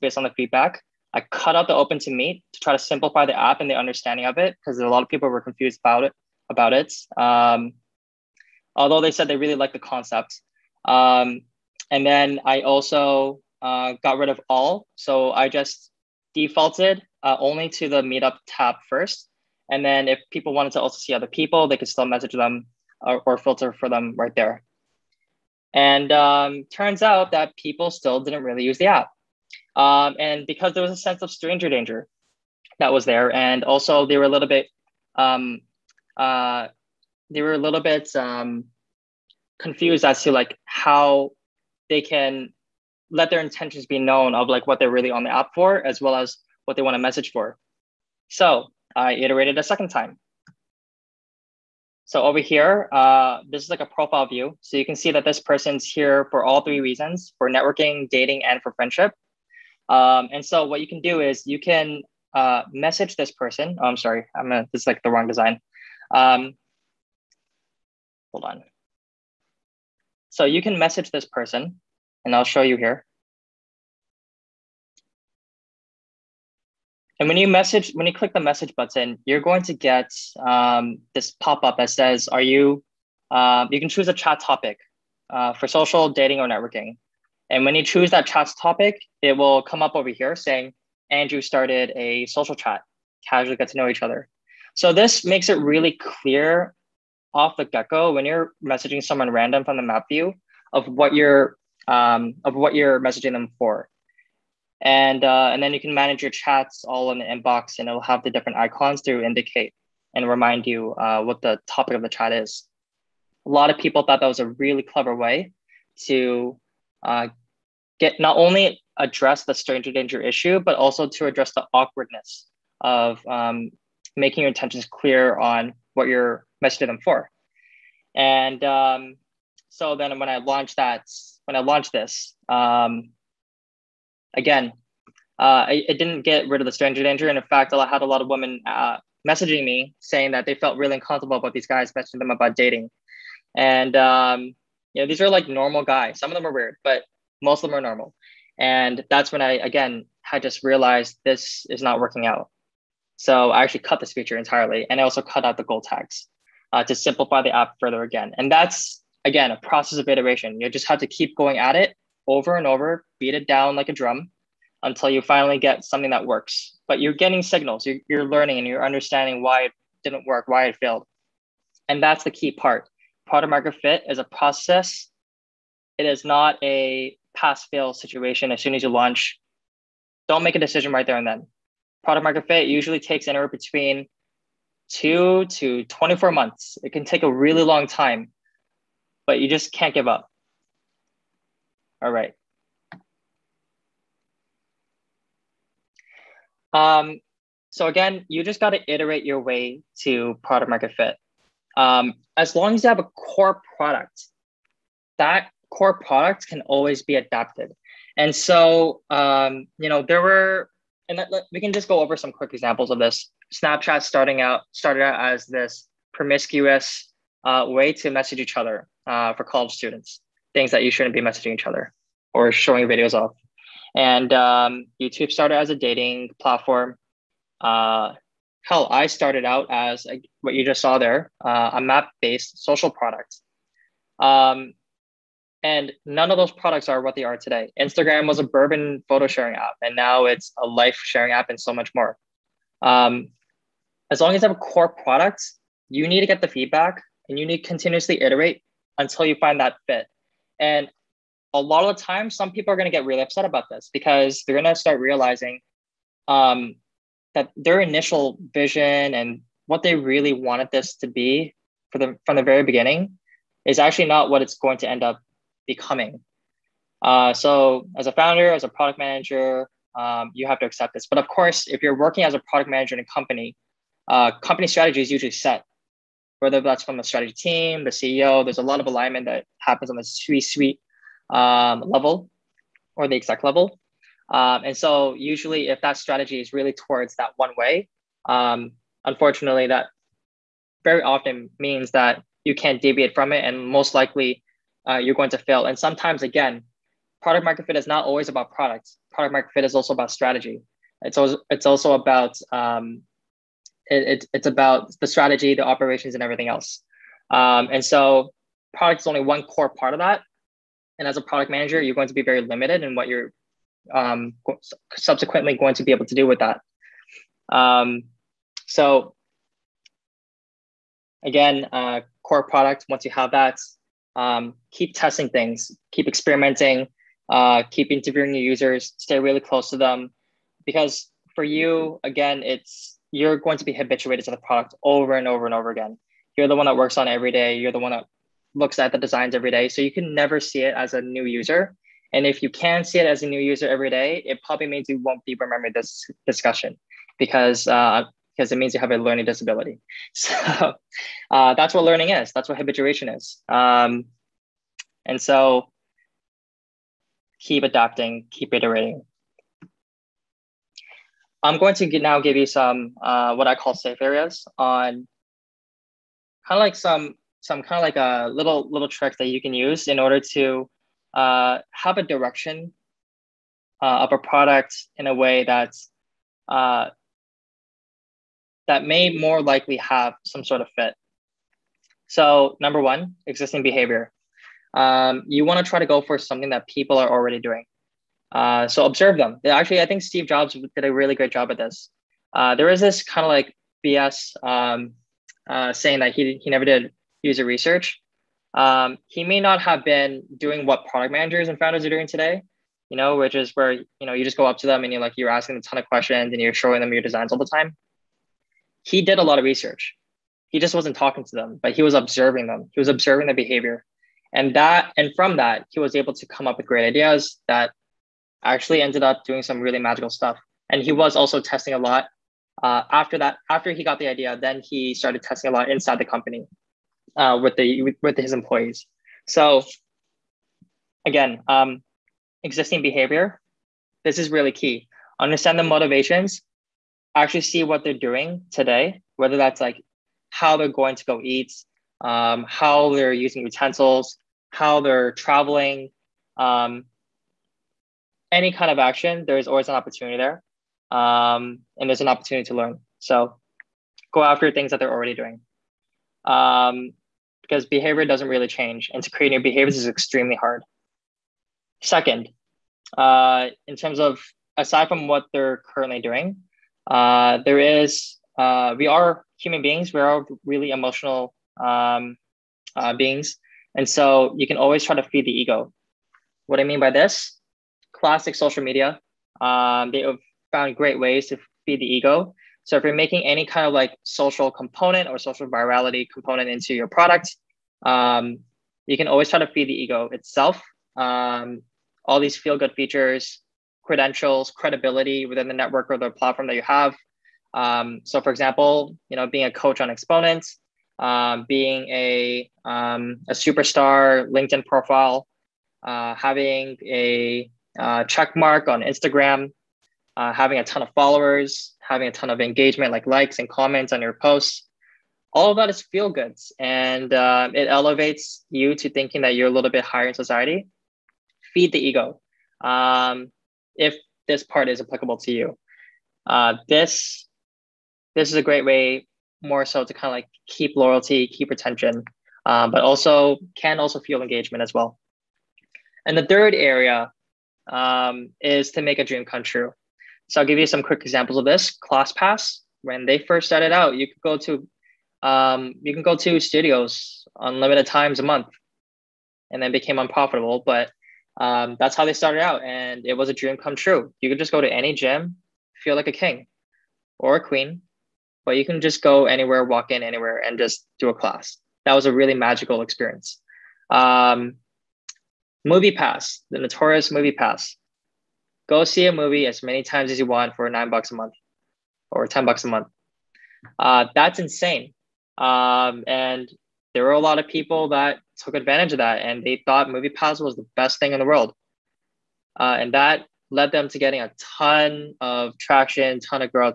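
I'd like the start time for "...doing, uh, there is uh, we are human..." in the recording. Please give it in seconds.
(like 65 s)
466 s.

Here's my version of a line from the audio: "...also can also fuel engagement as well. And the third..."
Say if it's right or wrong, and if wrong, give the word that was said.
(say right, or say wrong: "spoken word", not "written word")
right.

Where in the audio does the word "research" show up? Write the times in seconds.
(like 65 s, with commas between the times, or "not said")
397 s, 409 s.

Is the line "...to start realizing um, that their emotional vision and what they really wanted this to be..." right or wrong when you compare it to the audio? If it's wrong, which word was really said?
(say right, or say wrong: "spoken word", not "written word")
wrong: "initial", not "emotional".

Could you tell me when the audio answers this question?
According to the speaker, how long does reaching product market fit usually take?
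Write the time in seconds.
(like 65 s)
184 s.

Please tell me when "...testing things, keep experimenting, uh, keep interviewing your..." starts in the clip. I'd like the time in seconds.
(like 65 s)
324 s.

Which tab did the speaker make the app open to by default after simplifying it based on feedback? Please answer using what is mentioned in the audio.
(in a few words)
Meetup tab.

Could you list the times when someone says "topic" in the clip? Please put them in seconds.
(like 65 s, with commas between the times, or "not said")
84 s, 88 s, 111 s.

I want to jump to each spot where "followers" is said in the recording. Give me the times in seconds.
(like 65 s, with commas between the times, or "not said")
510 s.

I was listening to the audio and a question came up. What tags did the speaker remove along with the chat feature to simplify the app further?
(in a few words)
Goal tags.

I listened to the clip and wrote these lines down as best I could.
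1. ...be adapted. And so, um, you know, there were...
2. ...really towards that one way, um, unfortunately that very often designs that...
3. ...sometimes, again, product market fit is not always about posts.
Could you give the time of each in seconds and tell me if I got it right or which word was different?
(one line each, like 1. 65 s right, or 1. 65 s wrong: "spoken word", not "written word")
1. 207 s right
2. 286 s wrong: "means", not "designs"
3. 295 s wrong: "products", not "posts".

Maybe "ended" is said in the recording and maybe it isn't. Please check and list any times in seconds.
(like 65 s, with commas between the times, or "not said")
418 s.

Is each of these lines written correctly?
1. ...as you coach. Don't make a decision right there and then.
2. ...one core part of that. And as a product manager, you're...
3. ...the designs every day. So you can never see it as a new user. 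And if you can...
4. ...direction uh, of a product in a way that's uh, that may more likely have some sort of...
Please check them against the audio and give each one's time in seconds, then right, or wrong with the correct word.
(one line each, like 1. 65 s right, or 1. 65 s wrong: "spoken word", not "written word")
1. 178 s wrong: "launch", not "coach"
2. 309 s right
3. 338 s right
4. 372 s right.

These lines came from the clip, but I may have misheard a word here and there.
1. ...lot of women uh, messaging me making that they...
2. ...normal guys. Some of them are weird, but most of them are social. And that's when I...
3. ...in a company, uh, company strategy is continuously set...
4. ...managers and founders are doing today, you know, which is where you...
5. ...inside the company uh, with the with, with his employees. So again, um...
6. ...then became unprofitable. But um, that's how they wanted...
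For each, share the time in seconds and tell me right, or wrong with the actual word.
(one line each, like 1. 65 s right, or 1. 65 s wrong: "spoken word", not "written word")
1. 138 s wrong: "saying", not "making"
2. 145 s wrong: "normal", not "social"
3. 272 s wrong: "usually", not "continuously"
4. 401 s right
5. 425 s right
6. 549 s wrong: "started", not "wanted".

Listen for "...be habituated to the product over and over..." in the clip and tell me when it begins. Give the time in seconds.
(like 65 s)
333 s.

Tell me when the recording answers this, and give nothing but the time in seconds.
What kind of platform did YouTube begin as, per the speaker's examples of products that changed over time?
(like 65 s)
225 s.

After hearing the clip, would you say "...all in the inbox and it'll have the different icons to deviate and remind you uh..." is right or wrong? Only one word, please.
wrong.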